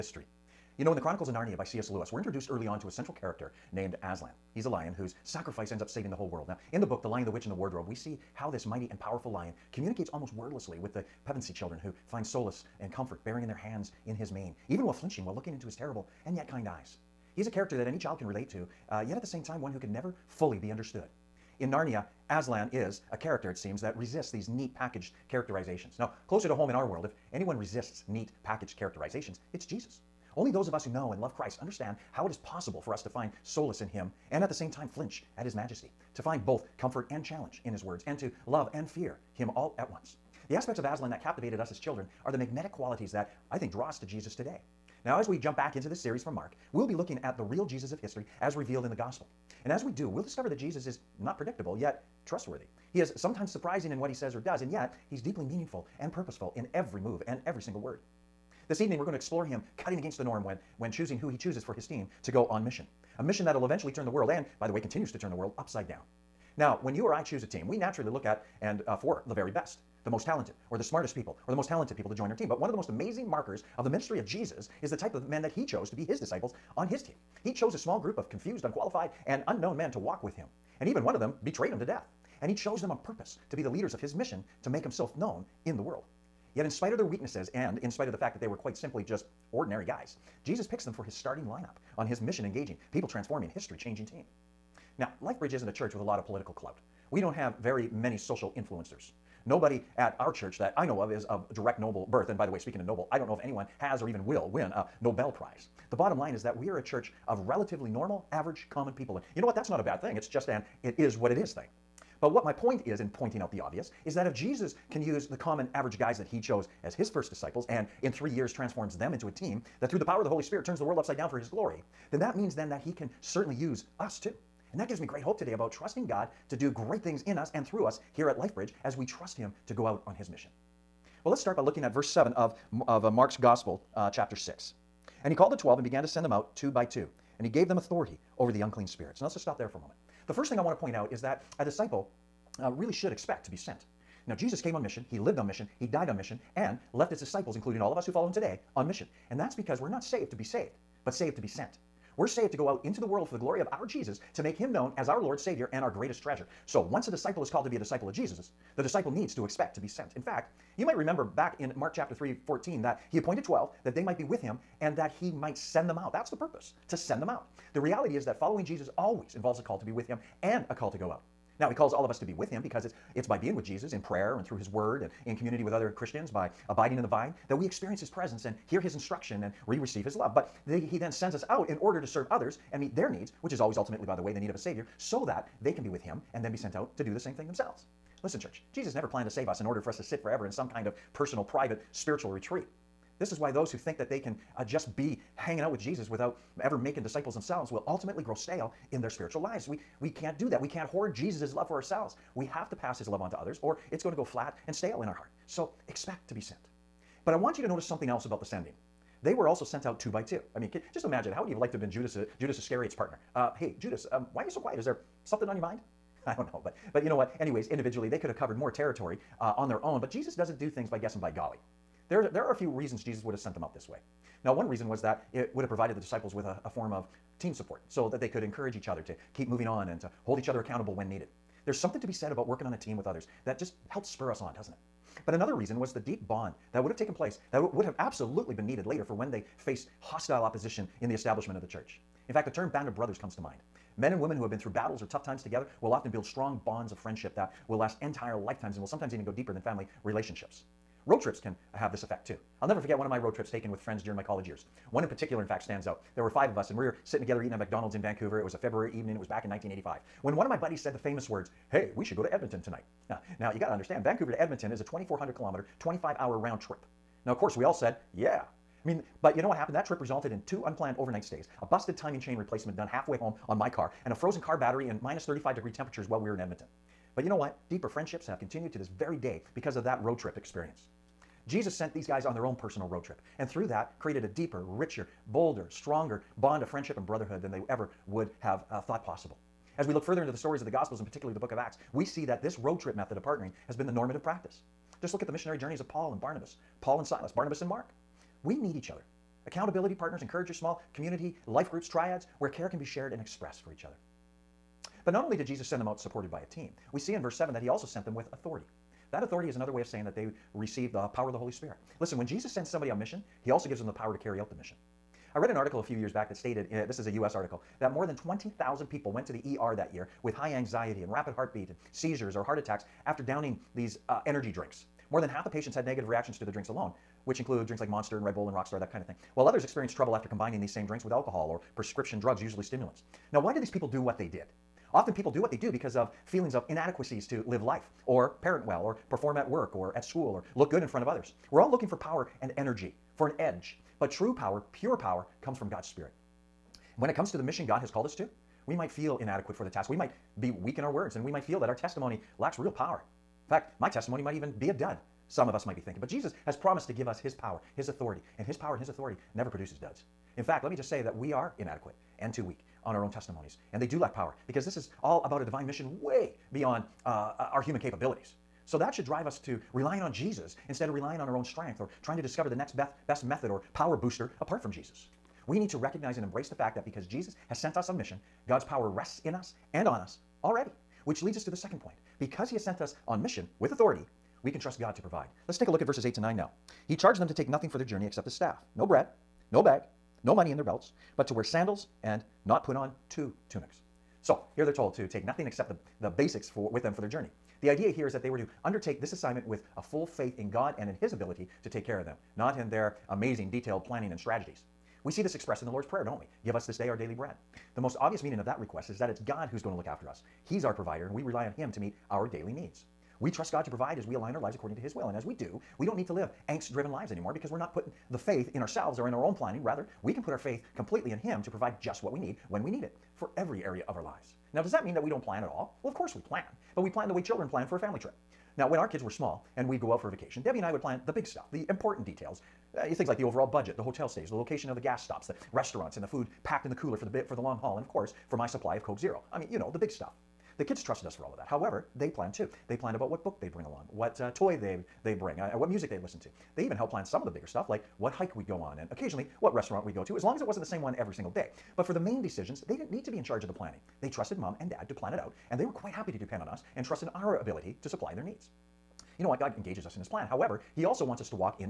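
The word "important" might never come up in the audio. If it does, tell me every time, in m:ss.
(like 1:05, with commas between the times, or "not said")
7:11.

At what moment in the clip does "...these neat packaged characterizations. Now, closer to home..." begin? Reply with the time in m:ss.
0:24.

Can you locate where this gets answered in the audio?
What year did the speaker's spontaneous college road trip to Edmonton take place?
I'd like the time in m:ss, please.
4:19.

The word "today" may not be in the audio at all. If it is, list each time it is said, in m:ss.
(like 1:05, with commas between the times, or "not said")
0:44, 2:05, 2:28.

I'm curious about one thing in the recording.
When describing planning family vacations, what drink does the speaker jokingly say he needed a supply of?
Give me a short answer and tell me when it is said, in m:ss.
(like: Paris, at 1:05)
Coke Zero, at 7:18.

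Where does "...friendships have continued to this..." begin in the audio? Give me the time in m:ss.
4:37.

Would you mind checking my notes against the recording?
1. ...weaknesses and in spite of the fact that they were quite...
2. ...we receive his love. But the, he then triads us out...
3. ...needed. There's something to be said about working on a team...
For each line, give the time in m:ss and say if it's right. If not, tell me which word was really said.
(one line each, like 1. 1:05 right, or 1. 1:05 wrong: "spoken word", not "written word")
1. 1:27 right
2. 2:59 wrong: "sends", not "triads"
3. 3:51 right.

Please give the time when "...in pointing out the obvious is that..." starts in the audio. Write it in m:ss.
1:52.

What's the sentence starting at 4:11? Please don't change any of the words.
Road trips can have this effect too.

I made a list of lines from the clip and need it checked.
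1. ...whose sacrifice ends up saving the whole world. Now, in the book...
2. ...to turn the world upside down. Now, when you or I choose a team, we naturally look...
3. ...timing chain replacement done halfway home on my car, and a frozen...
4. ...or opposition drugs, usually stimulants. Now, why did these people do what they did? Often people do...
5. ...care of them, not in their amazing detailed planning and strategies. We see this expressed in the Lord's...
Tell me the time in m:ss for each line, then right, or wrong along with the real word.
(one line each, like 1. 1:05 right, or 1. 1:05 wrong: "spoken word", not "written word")
1. 0:04 right
2. 1:05 right
3. 4:31 right
4. 5:31 wrong: "prescription", not "opposition"
5. 6:41 right.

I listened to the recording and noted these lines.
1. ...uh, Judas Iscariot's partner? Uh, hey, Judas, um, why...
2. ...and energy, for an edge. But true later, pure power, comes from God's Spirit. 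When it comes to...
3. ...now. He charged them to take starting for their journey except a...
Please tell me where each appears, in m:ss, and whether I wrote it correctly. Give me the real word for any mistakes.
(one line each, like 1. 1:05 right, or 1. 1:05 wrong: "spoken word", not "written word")
1. 3:32 right
2. 5:42 wrong: "power", not "later"
3. 6:26 wrong: "nothing", not "starting".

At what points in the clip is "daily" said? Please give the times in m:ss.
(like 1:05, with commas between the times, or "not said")
6:46, 6:52.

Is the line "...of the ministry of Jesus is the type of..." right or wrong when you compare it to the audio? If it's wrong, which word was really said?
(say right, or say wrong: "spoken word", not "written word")
right.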